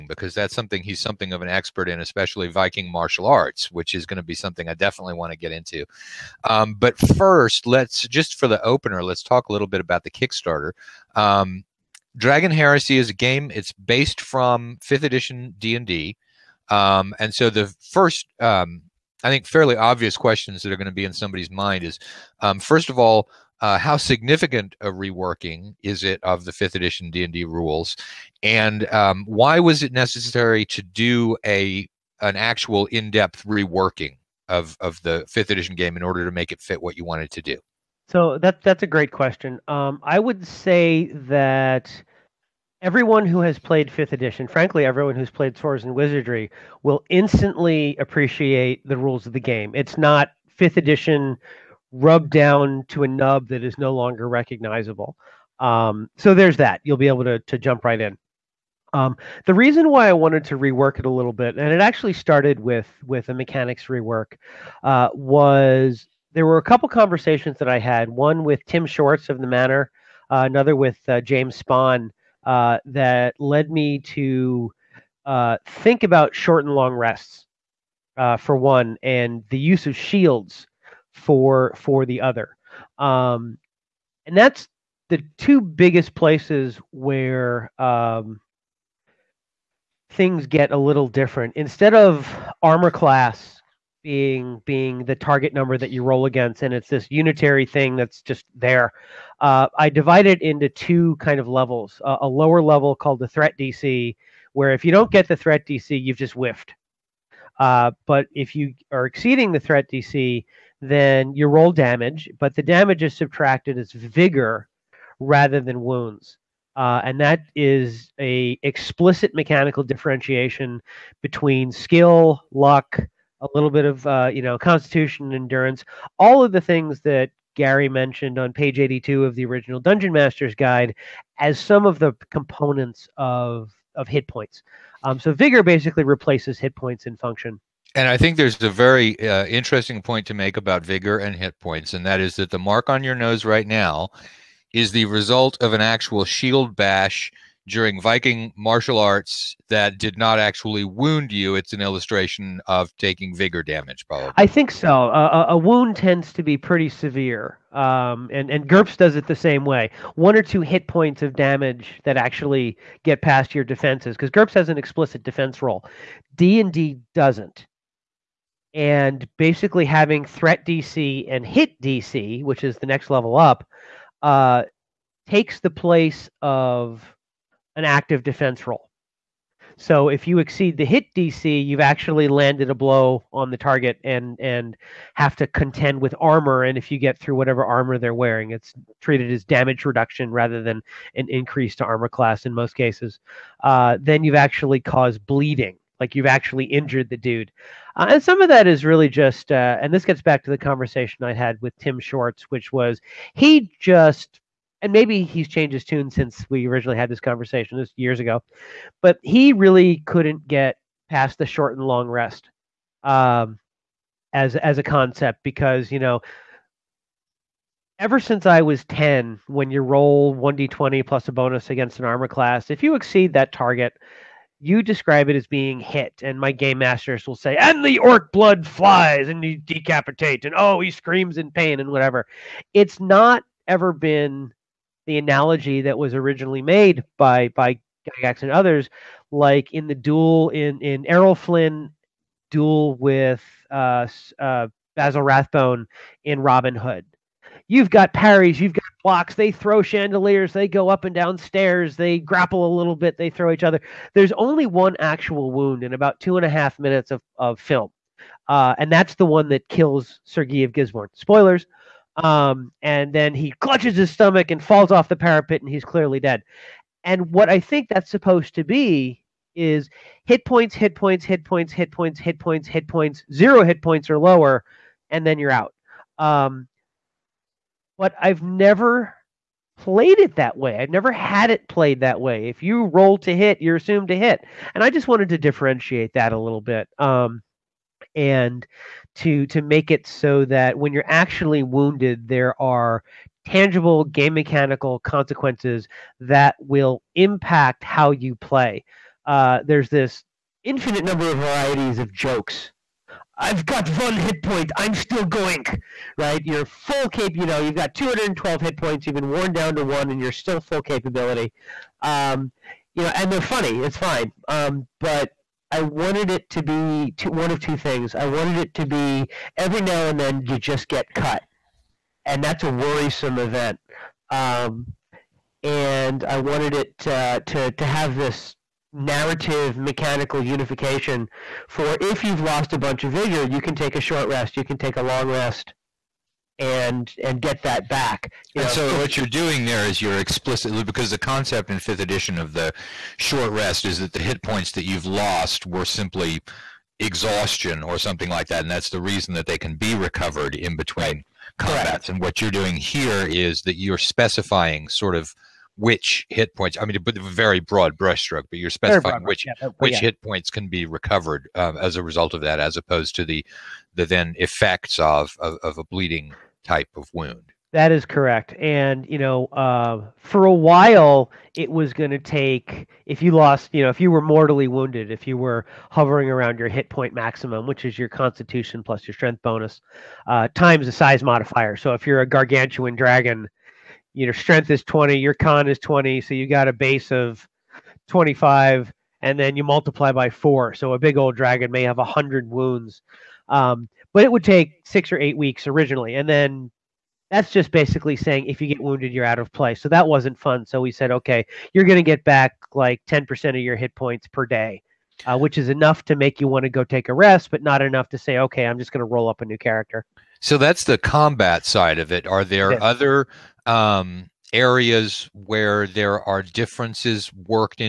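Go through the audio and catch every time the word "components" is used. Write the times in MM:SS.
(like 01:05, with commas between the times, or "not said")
02:12.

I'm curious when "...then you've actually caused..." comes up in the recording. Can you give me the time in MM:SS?
03:13.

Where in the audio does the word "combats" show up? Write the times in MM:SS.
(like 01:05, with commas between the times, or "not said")
05:51, 06:50.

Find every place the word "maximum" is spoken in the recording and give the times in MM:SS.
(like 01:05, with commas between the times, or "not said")
06:17.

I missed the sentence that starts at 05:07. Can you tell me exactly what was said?
You know, you've got 212 hit points.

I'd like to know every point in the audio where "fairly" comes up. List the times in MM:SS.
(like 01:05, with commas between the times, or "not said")
00:19.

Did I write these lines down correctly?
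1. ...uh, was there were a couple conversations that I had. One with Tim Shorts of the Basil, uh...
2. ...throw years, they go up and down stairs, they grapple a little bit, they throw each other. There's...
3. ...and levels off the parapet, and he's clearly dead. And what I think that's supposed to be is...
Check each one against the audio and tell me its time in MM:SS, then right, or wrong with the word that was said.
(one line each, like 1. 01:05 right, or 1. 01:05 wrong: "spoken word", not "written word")
1. 01:04 wrong: "Manor", not "Basil"
2. 04:09 wrong: "chandeliers", not "years"
3. 04:24 wrong: "falls", not "levels".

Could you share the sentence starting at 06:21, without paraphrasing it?
So if you're a gargantuan dragon, your know, strength is 20, your con is 20.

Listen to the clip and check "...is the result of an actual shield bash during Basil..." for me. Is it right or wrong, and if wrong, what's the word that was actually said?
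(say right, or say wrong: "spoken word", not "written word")
wrong: "Viking", not "Basil".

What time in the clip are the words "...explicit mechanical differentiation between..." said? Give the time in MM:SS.
01:58.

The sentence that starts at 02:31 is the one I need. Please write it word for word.
It's an illustration of taking vigor damage, probably.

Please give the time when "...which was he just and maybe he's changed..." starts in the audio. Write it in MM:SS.
03:22.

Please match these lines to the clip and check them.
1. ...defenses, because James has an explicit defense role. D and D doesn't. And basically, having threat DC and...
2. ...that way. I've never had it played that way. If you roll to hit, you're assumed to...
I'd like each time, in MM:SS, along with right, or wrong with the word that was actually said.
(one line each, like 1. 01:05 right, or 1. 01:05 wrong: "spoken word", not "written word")
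1. 02:43 wrong: "GURPS", not "James"
2. 04:40 right.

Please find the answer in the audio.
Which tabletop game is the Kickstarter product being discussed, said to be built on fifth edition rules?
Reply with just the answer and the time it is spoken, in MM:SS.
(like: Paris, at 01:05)
Dragon Heresy, at 00:12.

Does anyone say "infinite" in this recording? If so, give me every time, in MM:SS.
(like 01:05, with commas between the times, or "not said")
05:00.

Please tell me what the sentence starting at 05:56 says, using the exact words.
I mean, but very broad brushstroke, but you're specifying which yeah, but, but which yeah.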